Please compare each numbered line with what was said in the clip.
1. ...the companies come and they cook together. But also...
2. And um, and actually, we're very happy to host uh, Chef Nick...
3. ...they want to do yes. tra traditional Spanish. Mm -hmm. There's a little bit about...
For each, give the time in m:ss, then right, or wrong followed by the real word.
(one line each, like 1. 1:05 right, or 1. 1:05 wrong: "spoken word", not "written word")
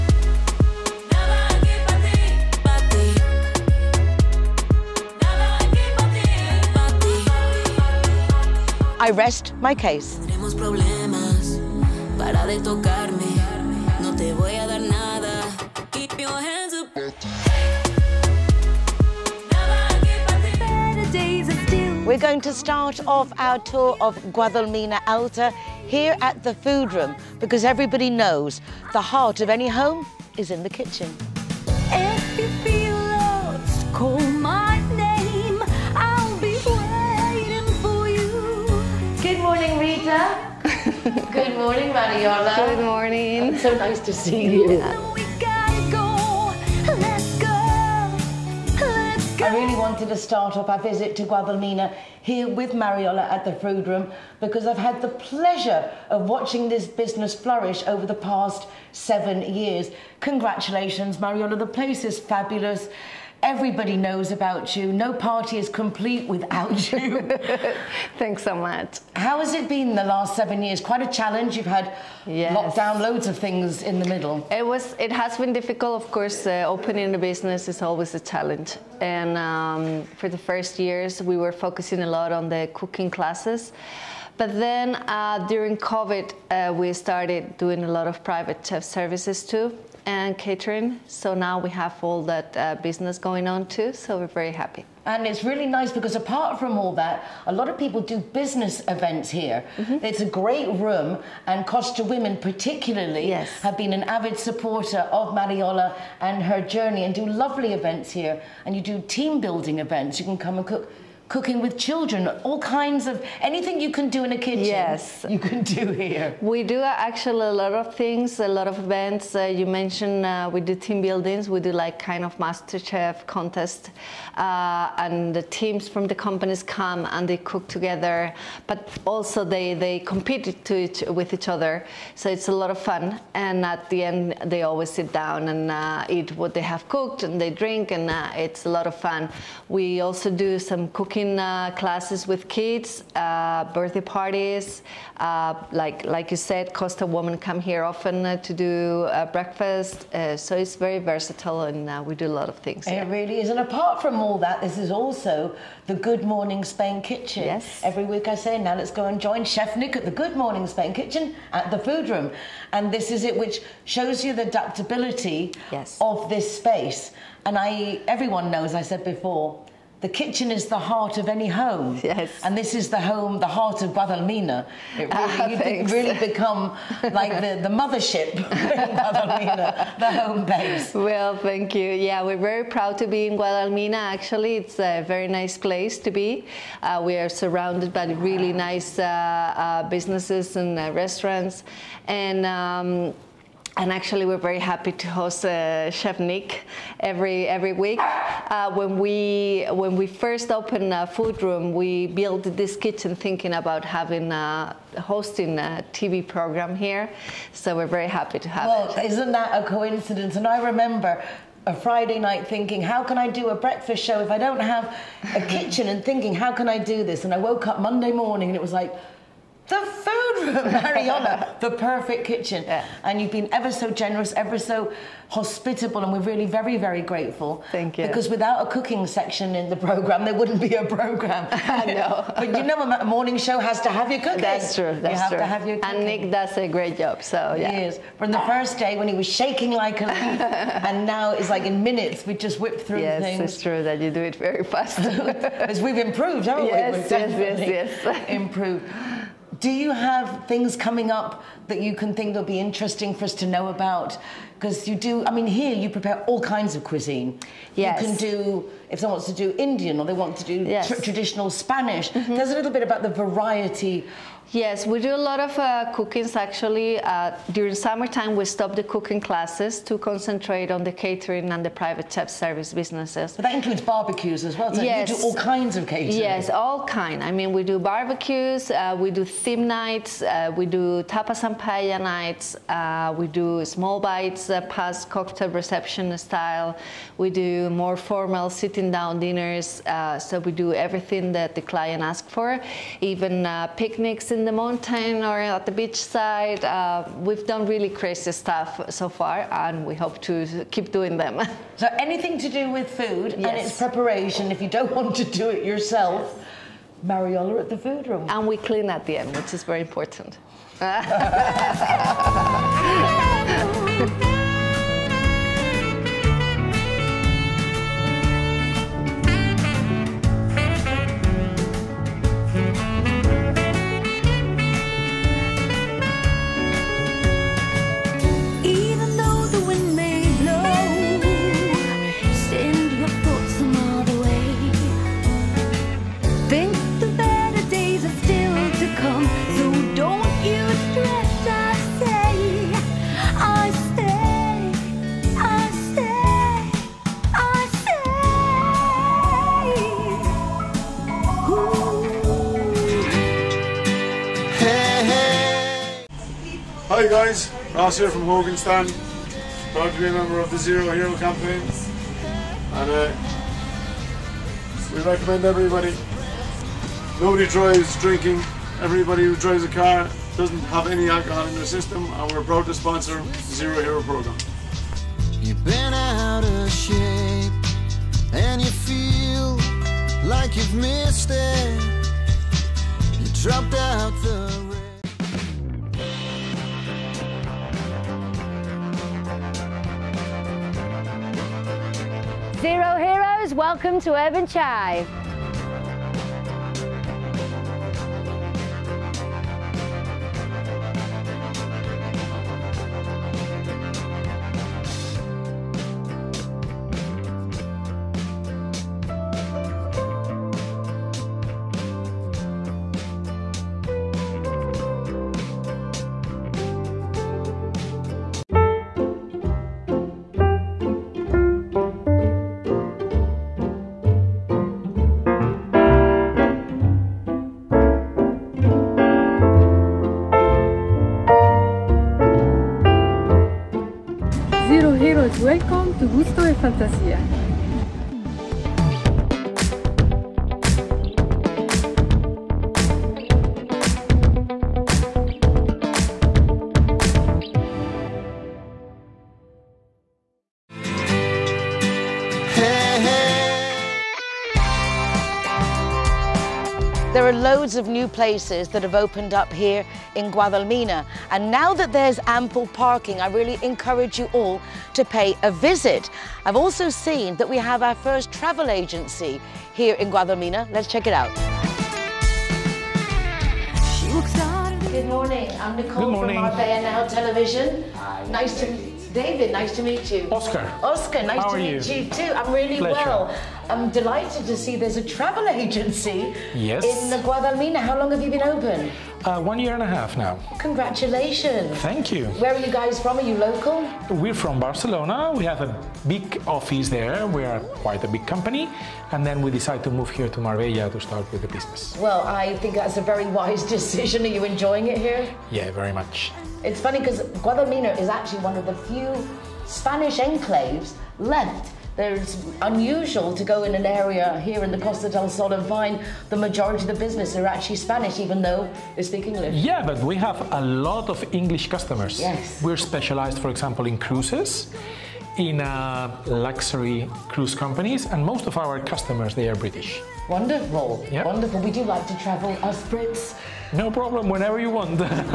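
1. 2:06 right
2. 3:12 right
3. 4:20 right.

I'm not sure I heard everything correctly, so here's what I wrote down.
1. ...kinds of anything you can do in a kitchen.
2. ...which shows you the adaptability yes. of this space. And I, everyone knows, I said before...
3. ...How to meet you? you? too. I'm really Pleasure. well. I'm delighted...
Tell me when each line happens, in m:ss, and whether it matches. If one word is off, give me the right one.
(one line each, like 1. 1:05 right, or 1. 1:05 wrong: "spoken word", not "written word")
1. 1:52 right
2. 2:43 right
3. 8:01 right.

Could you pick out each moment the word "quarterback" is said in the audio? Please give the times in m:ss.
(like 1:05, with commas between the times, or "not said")
not said.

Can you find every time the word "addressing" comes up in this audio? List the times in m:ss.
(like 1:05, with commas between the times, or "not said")
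not said.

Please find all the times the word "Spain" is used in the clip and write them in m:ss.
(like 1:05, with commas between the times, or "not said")
2:36, 2:40.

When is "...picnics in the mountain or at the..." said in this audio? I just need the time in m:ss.
4:53.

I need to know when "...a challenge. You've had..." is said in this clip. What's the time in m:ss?
1:11.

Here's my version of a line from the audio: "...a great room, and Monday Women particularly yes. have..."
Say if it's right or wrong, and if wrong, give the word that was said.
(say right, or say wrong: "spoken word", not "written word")
wrong: "Costa", not "Monday".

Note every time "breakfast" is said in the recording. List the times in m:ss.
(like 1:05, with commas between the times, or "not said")
2:29, 3:33.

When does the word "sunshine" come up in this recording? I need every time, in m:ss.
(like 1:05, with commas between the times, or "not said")
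not said.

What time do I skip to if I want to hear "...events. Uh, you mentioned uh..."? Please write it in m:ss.
1:58.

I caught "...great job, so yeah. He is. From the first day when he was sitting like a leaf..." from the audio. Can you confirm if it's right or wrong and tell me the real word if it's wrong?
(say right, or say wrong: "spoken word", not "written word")
wrong: "shaking", not "sitting".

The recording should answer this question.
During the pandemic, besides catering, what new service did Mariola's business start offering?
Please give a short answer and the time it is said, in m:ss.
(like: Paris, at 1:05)
private chef services, at 1:28.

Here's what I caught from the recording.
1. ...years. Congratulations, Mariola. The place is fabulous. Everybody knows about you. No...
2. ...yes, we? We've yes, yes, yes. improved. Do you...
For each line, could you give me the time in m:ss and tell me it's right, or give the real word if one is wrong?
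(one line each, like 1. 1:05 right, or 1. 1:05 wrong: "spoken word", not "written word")
1. 0:59 right
2. 4:06 right.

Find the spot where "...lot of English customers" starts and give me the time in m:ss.
8:40.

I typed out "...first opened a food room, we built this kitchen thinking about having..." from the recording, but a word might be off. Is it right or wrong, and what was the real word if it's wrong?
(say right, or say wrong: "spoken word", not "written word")
right.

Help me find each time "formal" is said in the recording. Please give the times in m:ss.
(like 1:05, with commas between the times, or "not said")
4:47.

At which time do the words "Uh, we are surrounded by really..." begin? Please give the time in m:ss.
3:06.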